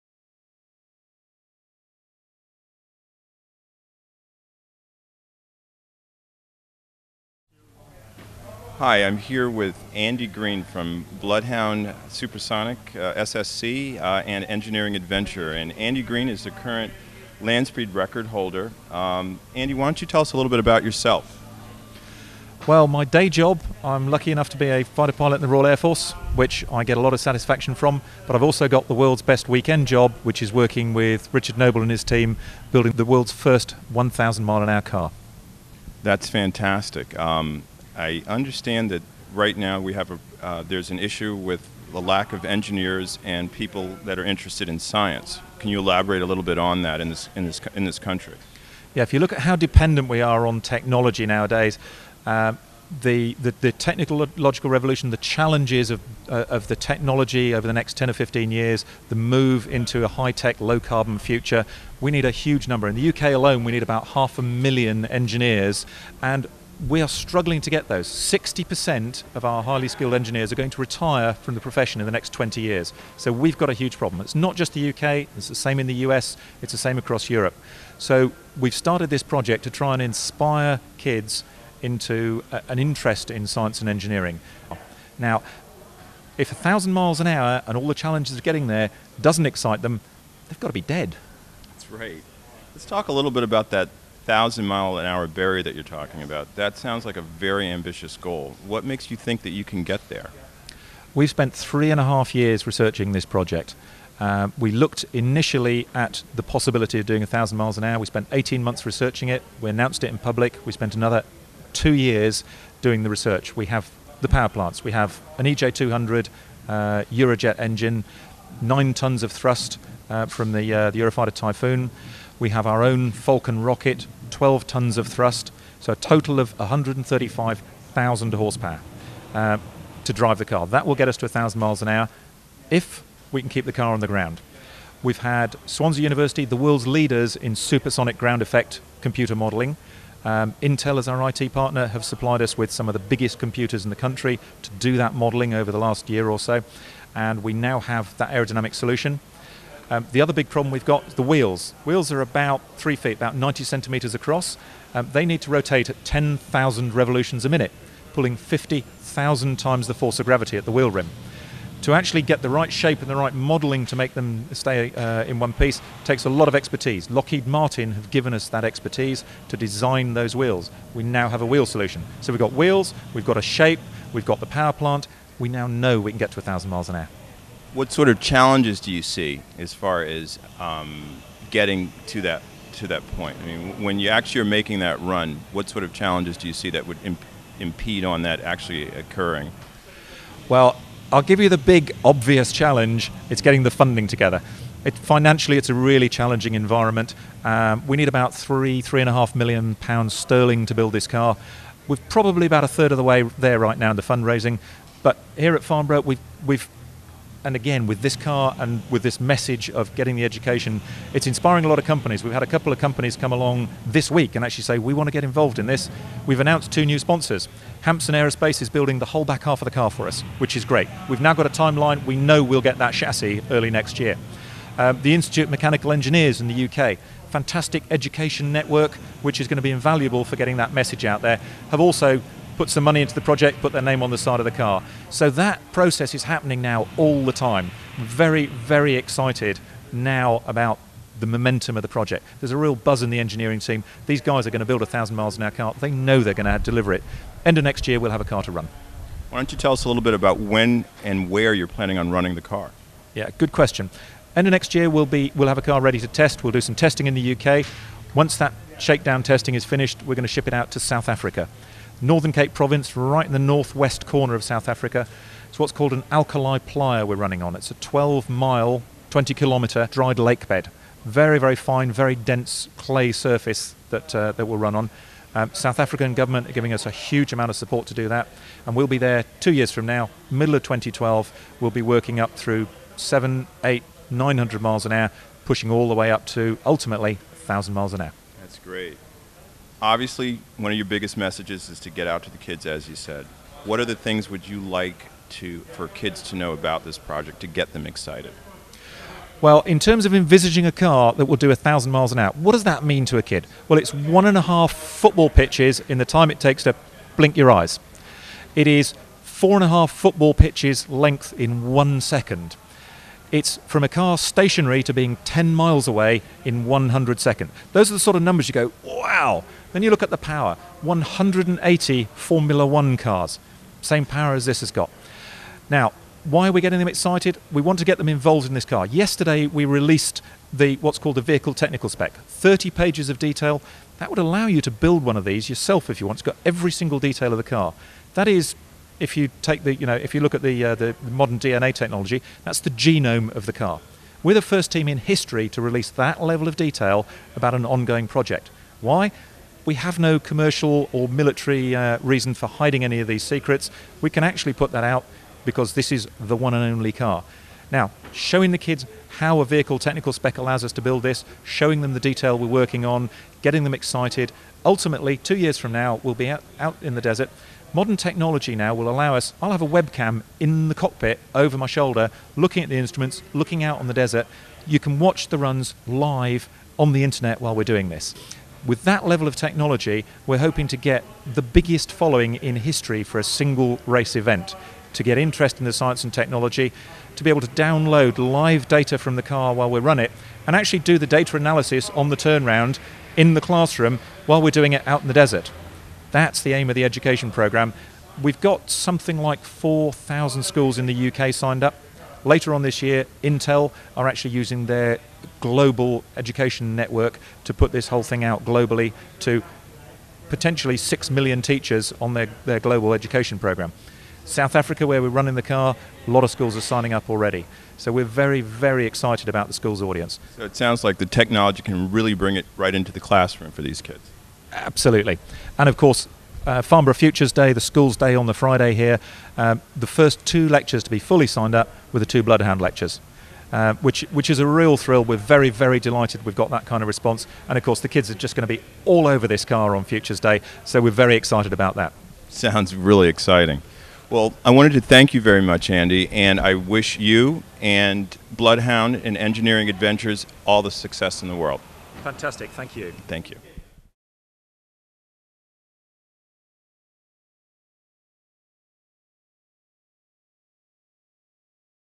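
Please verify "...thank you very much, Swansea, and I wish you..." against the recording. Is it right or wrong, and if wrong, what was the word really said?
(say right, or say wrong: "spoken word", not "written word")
wrong: "Andy", not "Swansea".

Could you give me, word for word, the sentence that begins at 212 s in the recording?
We've had a couple of companies come along this week and actually say, we want to get involved in this.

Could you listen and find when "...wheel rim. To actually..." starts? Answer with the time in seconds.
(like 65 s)
160 s.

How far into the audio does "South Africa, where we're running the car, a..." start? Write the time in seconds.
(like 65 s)
414 s.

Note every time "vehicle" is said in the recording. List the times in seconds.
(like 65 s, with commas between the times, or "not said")
331 s, 359 s.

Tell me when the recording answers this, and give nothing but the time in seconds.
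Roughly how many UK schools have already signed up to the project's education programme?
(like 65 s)
399 s.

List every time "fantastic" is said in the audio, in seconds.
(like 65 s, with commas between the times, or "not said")
36 s, 227 s, 452 s.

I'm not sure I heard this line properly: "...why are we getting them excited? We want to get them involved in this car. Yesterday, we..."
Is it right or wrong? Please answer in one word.
right.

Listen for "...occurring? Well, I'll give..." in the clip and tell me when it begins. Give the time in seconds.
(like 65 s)
188 s.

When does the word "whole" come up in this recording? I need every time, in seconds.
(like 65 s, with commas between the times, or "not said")
219 s, 407 s.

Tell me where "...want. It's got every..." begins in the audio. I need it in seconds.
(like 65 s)
336 s.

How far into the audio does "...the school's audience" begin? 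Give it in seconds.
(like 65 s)
419 s.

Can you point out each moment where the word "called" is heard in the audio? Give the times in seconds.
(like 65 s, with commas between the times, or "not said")
265 s, 330 s.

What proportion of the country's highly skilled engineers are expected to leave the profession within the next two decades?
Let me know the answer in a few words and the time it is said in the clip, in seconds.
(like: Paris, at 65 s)
60%, at 68 s.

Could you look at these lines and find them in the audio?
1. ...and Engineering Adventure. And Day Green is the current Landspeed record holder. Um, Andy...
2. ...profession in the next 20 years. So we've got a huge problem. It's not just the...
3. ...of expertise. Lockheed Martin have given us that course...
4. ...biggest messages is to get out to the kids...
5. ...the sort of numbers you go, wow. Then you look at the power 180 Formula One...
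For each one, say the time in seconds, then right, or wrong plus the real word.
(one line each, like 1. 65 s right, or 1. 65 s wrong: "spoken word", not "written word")
1. 14 s wrong: "Andy", not "Day"
2. 71 s right
3. 166 s wrong: "expertise", not "course"
4. 290 s right
5. 317 s right.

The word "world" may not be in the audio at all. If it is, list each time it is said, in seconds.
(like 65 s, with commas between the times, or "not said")
28 s, 33 s, 136 s, 451 s.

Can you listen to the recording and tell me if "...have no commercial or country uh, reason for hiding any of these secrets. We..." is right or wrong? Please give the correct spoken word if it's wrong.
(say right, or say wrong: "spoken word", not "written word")
wrong: "military", not "country".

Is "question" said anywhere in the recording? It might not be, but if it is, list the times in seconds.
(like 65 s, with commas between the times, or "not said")
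253 s.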